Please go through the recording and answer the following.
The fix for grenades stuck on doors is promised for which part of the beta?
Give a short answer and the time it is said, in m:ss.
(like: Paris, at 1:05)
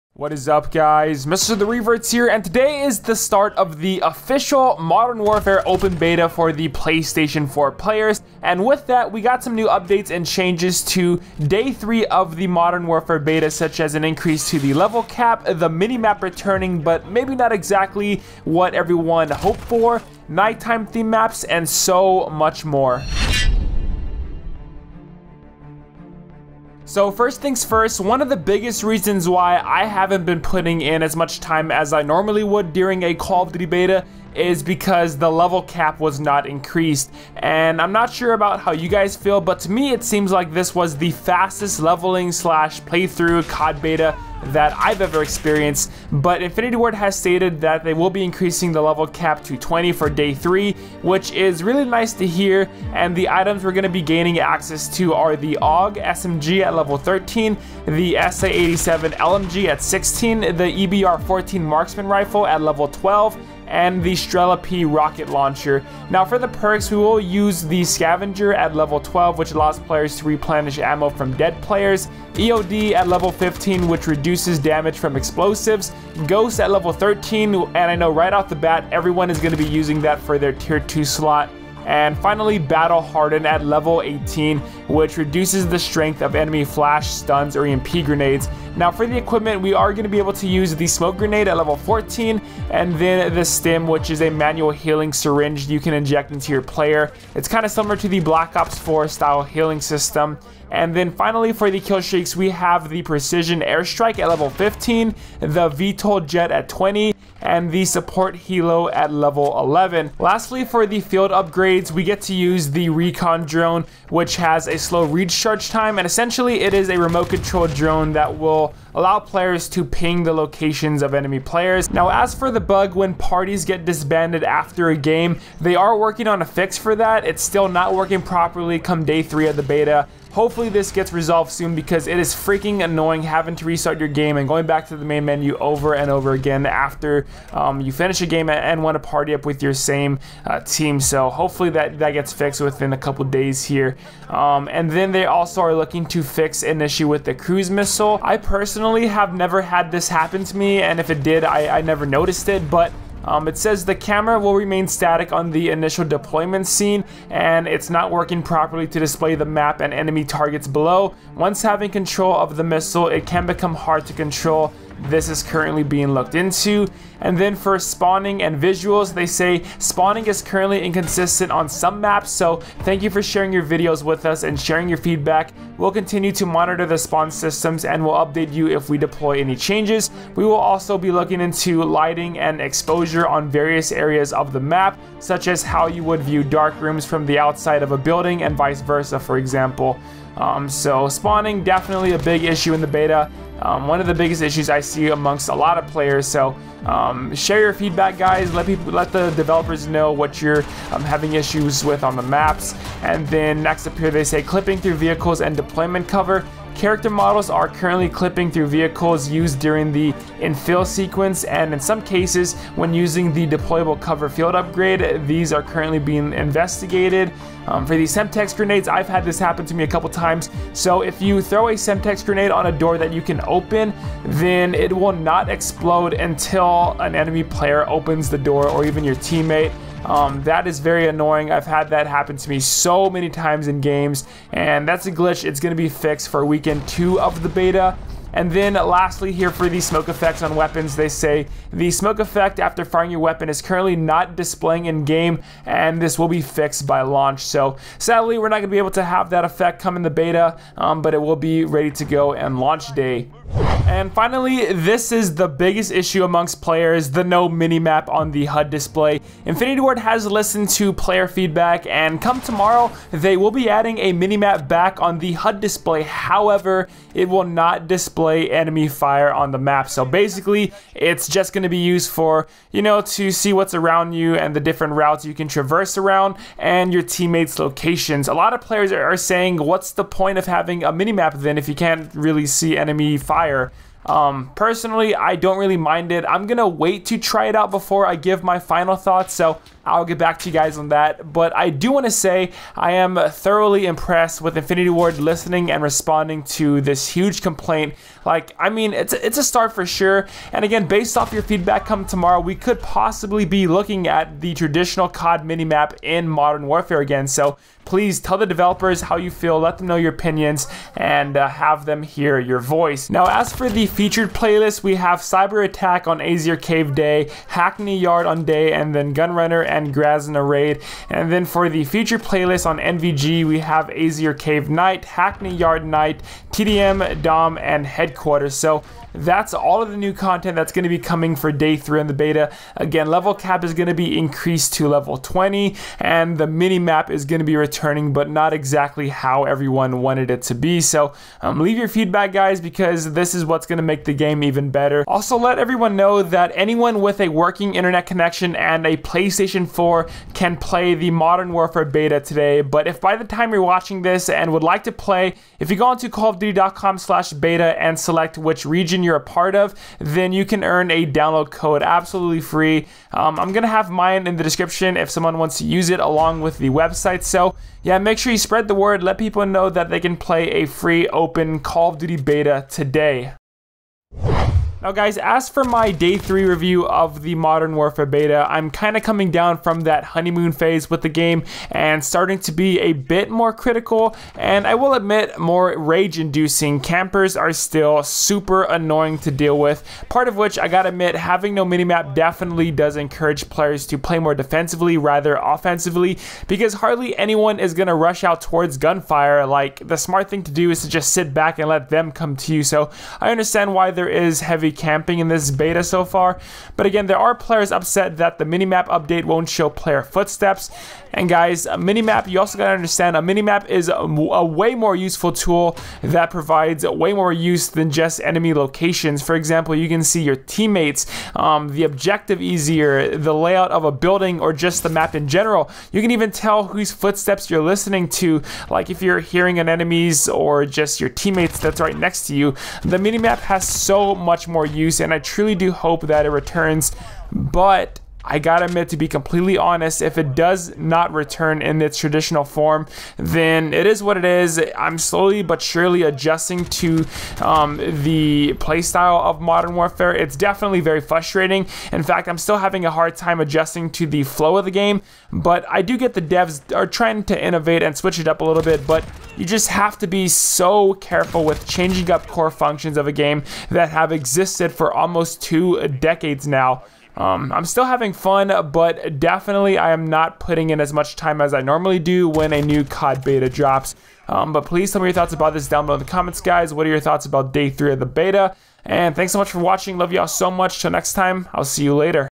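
Weekend two, at 3:56.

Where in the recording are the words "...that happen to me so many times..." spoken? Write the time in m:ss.
3:51.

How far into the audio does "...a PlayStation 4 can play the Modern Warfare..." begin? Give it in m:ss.
5:48.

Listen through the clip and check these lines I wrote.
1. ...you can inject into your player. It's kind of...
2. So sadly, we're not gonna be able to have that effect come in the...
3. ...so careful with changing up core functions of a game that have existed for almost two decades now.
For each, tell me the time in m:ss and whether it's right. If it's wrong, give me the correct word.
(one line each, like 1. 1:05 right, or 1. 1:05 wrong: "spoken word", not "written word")
1. 1:35 right
2. 4:07 right
3. 7:40 right.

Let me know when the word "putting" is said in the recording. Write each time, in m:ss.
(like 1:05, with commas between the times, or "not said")
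0:30, 7:50.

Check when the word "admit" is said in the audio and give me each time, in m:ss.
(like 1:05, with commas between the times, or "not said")
6:24, 6:30, 7:18.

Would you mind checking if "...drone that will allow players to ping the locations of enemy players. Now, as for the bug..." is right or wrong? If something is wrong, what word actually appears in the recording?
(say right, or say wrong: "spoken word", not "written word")
right.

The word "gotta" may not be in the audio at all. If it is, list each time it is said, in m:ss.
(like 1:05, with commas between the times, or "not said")
6:30, 6:52, 7:18.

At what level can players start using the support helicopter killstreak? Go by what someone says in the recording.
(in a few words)
11.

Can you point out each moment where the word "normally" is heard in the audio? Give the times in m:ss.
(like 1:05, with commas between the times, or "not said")
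0:32, 7:51.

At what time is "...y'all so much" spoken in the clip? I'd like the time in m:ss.
8:00.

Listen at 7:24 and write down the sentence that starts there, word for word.
I'm slowly but surely adjusting to um, the playstyle of Modern Warfare.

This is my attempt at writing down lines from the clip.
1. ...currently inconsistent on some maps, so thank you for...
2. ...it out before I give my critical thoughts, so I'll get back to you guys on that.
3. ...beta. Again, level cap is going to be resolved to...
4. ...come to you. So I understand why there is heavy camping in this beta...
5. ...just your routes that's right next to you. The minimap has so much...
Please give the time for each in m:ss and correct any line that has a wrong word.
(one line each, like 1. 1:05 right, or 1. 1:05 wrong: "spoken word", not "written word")
1. 2:50 right
2. 4:47 wrong: "final", not "critical"
3. 5:32 wrong: "increased", not "resolved"
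4. 6:42 right
5. 7:10 wrong: "teammates", not "routes".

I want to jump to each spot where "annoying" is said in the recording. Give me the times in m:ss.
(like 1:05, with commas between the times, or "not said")
2:12, 3:51, 6:28.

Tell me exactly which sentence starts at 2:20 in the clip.
So hopefully that, that gets fixed within a couple days here.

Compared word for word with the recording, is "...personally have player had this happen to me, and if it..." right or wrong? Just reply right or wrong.
wrong.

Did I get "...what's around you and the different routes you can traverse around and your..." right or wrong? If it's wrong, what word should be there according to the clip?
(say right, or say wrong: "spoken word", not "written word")
right.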